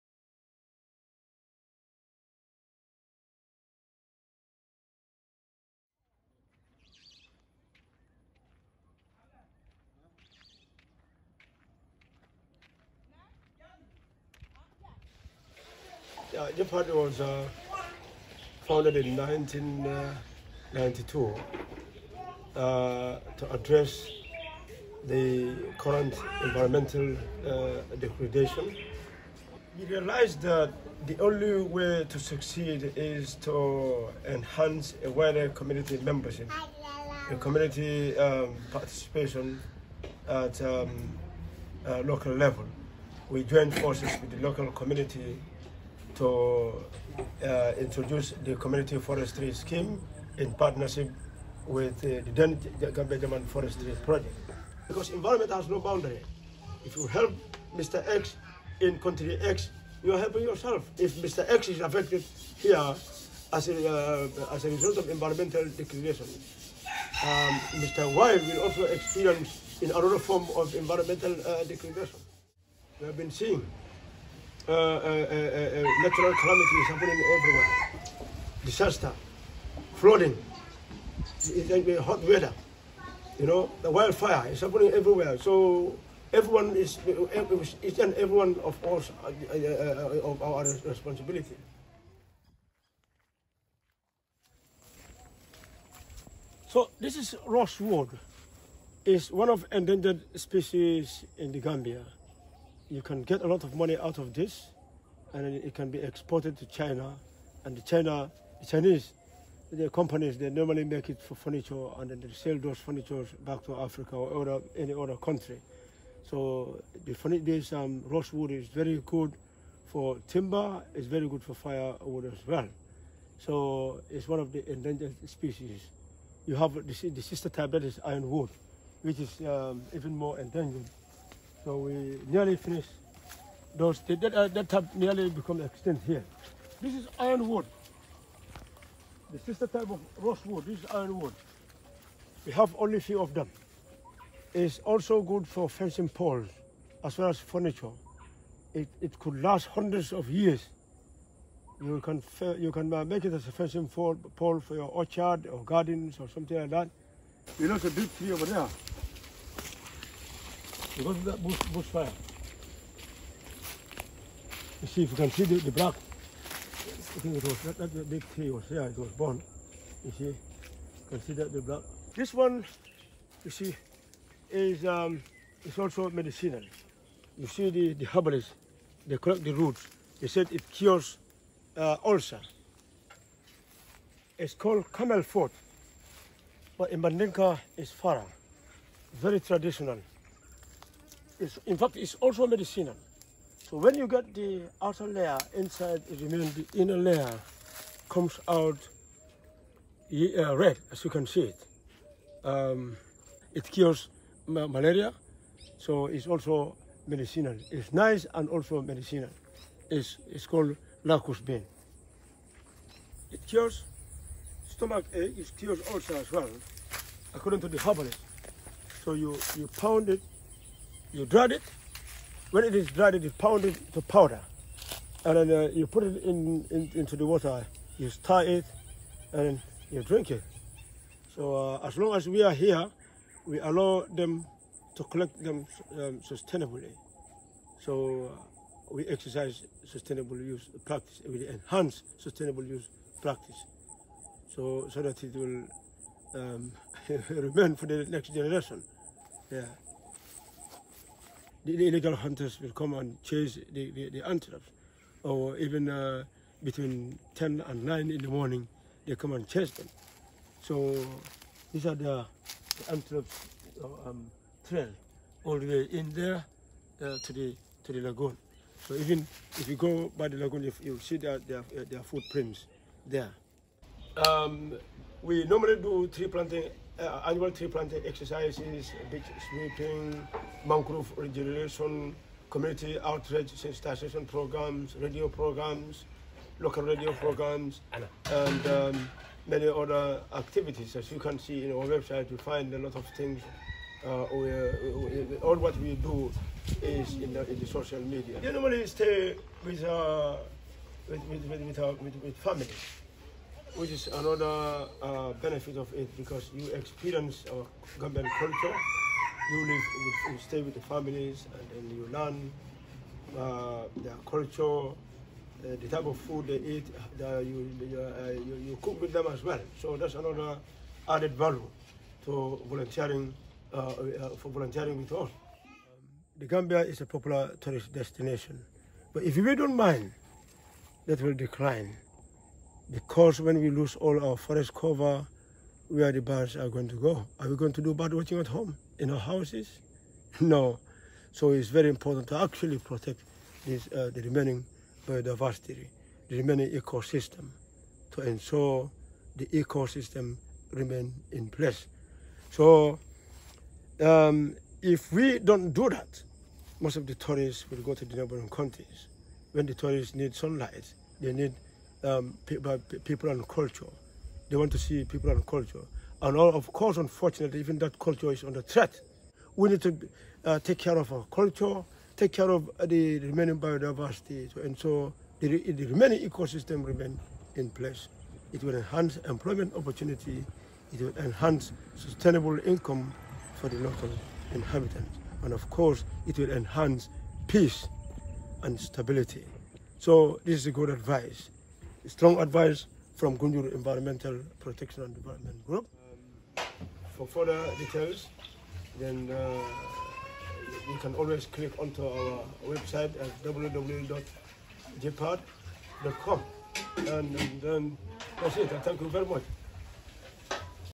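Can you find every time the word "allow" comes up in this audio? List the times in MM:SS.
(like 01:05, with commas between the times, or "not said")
03:53.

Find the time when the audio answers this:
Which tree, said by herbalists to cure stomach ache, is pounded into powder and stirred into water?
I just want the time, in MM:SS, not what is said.
03:31.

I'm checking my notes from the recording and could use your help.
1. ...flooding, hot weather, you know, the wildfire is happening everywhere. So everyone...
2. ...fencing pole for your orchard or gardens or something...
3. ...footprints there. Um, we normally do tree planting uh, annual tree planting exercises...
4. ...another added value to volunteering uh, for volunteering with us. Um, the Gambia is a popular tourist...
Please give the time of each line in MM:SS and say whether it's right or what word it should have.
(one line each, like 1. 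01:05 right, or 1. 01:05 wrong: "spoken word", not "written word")
1. 01:19 right
2. 02:33 right
3. 04:32 right
4. 05:20 right.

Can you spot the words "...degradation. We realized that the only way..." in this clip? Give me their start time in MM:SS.
00:27.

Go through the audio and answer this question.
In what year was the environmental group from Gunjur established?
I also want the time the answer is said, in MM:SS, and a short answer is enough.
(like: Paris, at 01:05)
1992, at 00:19.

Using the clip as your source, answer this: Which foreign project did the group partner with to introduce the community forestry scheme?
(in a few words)
Gambia German Forestry Project.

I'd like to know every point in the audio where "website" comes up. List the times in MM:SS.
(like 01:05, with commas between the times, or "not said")
04:51, 06:42.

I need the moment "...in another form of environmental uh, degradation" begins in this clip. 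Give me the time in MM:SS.
01:09.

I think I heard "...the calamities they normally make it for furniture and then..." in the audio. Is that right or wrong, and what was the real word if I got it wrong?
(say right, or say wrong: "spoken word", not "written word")
wrong: "companies", not "calamities".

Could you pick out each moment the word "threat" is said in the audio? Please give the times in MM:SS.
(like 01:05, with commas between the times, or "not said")
06:08.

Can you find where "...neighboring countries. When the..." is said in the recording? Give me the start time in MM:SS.
05:58.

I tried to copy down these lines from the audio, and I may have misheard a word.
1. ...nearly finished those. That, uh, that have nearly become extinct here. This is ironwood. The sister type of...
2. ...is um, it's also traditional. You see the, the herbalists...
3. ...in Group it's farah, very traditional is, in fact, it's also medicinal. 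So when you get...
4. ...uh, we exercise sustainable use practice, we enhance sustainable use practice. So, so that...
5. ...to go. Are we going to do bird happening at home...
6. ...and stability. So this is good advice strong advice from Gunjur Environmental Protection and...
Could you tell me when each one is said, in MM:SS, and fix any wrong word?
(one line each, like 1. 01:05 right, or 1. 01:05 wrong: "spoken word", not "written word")
1. 02:12 right
2. 02:54 wrong: "medicinal", not "traditional"
3. 03:06 wrong: "Mandinka", not "Group"
4. 03:58 right
5. 05:36 wrong: "watching", not "happening"
6. 06:28 right.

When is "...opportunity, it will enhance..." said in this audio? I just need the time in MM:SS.
06:19.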